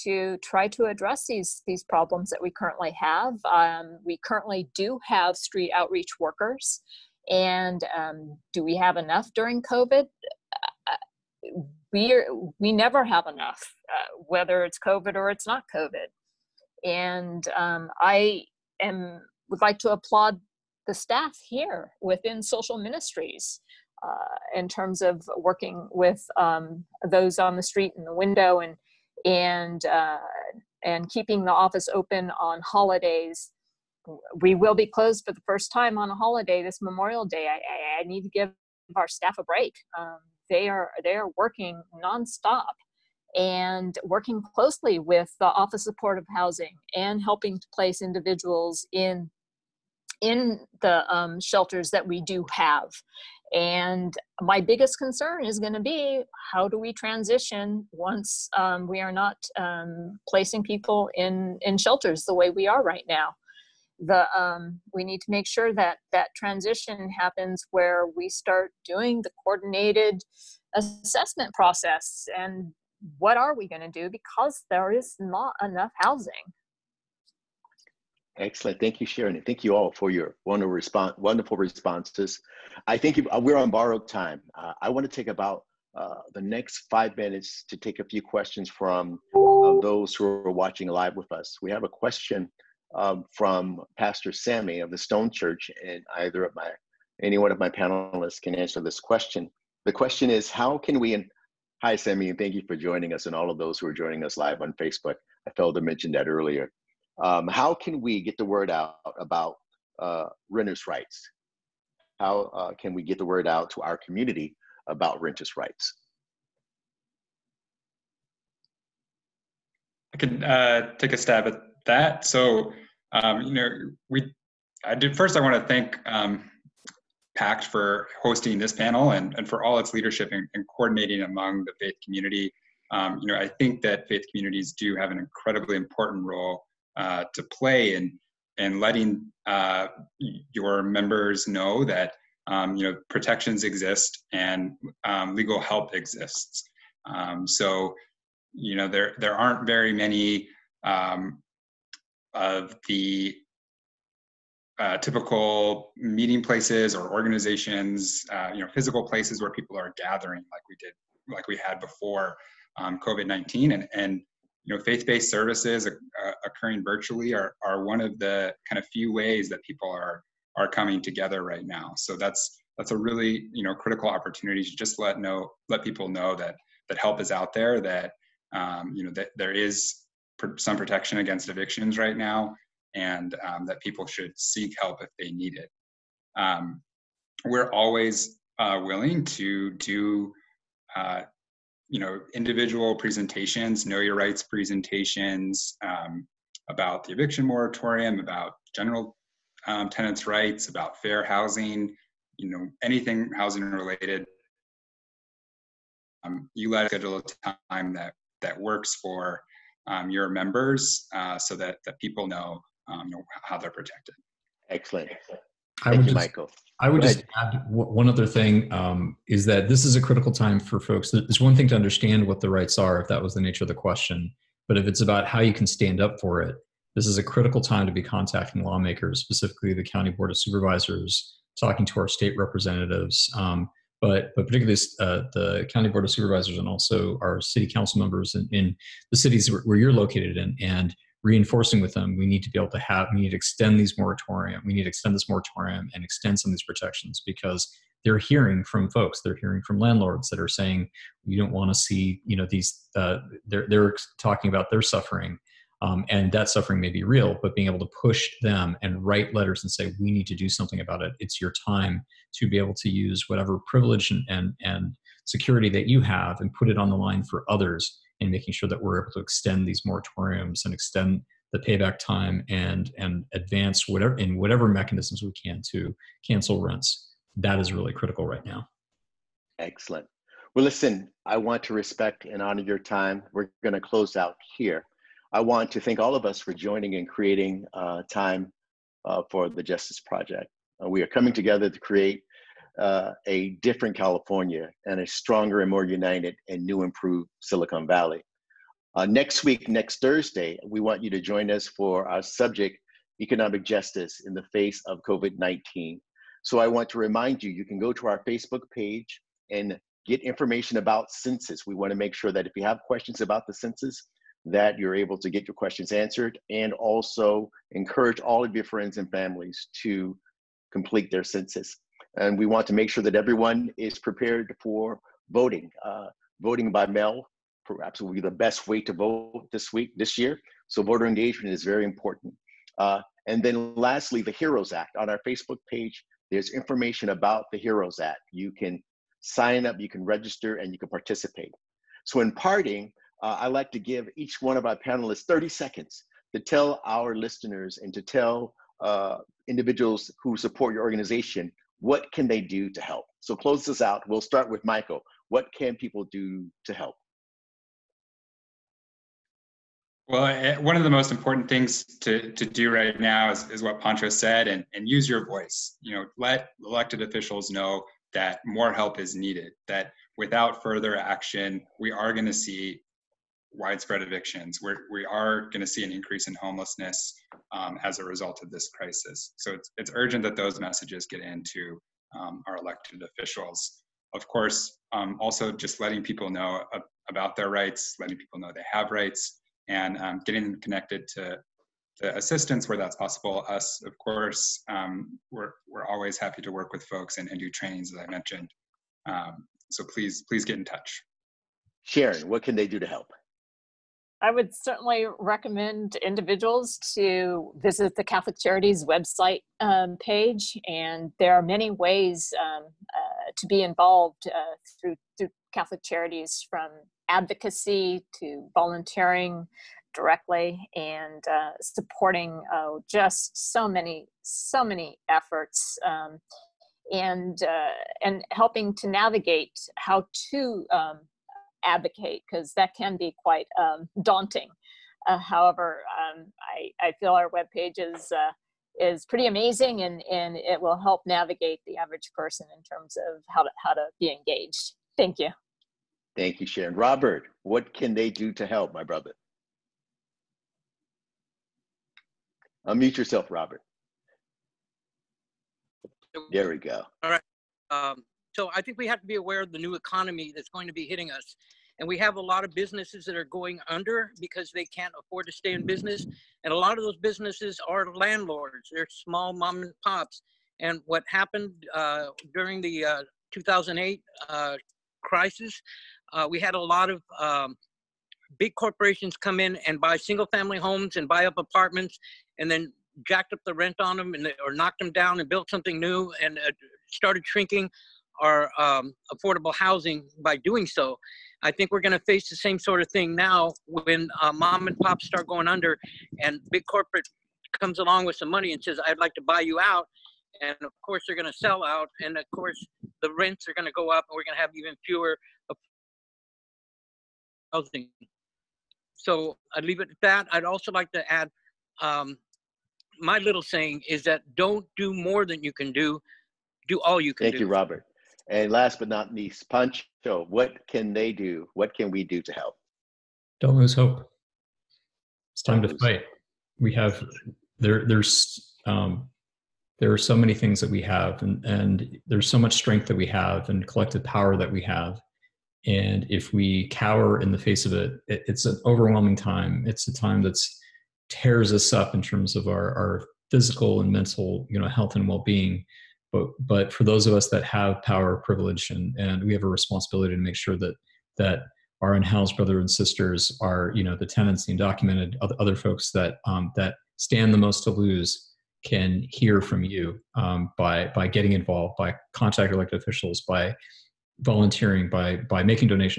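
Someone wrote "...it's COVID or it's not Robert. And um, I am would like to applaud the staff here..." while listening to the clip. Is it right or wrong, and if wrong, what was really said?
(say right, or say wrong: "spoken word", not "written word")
wrong: "COVID", not "Robert".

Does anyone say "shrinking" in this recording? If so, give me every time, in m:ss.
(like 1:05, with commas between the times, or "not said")
8:07.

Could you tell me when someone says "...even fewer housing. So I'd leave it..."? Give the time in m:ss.
8:24.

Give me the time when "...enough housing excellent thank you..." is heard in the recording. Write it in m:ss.
1:15.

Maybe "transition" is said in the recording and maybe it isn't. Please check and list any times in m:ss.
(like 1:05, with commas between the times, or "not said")
0:56, 1:06.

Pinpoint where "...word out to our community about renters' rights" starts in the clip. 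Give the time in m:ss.
1:53.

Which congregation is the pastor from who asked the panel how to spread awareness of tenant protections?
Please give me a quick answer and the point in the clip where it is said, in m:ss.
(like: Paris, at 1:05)
Stone Church, at 1:34.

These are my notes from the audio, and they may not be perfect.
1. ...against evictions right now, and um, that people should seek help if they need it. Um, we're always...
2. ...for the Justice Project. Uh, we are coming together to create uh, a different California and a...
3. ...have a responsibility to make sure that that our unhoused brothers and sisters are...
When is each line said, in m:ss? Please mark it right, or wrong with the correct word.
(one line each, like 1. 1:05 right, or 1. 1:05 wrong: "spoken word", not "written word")
1. 3:01 right
2. 4:49 right
3. 9:09 right.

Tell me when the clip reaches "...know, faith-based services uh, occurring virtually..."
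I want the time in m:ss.
2:44.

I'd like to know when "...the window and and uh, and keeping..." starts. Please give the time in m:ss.
0:28.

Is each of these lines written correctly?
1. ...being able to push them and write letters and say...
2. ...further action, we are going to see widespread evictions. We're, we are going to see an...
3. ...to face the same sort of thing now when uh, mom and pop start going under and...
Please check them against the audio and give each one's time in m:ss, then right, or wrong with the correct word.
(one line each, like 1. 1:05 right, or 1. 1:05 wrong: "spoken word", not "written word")
1. 4:17 right
2. 6:10 right
3. 8:11 right.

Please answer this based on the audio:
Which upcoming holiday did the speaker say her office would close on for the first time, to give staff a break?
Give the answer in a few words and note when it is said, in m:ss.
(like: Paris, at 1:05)
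Memorial Day, at 0:36.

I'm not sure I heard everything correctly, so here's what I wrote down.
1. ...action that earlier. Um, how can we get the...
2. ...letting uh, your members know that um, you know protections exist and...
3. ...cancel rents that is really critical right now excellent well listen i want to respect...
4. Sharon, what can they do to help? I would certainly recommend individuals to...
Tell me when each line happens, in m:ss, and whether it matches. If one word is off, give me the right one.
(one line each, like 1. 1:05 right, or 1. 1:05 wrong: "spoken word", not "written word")
1. 1:45 wrong: "mention", not "action"
2. 2:18 right
3. 4:36 right
4. 6:41 right.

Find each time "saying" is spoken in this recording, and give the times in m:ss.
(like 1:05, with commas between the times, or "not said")
4:10, 8:33.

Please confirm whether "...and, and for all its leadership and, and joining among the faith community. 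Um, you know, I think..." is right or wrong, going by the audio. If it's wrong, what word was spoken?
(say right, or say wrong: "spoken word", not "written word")
wrong: "coordinating", not "joining".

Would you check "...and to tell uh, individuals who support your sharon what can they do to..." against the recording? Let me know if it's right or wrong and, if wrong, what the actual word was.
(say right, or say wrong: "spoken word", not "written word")
wrong: "organization", not "sharon".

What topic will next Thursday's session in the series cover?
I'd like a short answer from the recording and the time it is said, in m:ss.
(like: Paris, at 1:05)
Economic Justice, at 5:03.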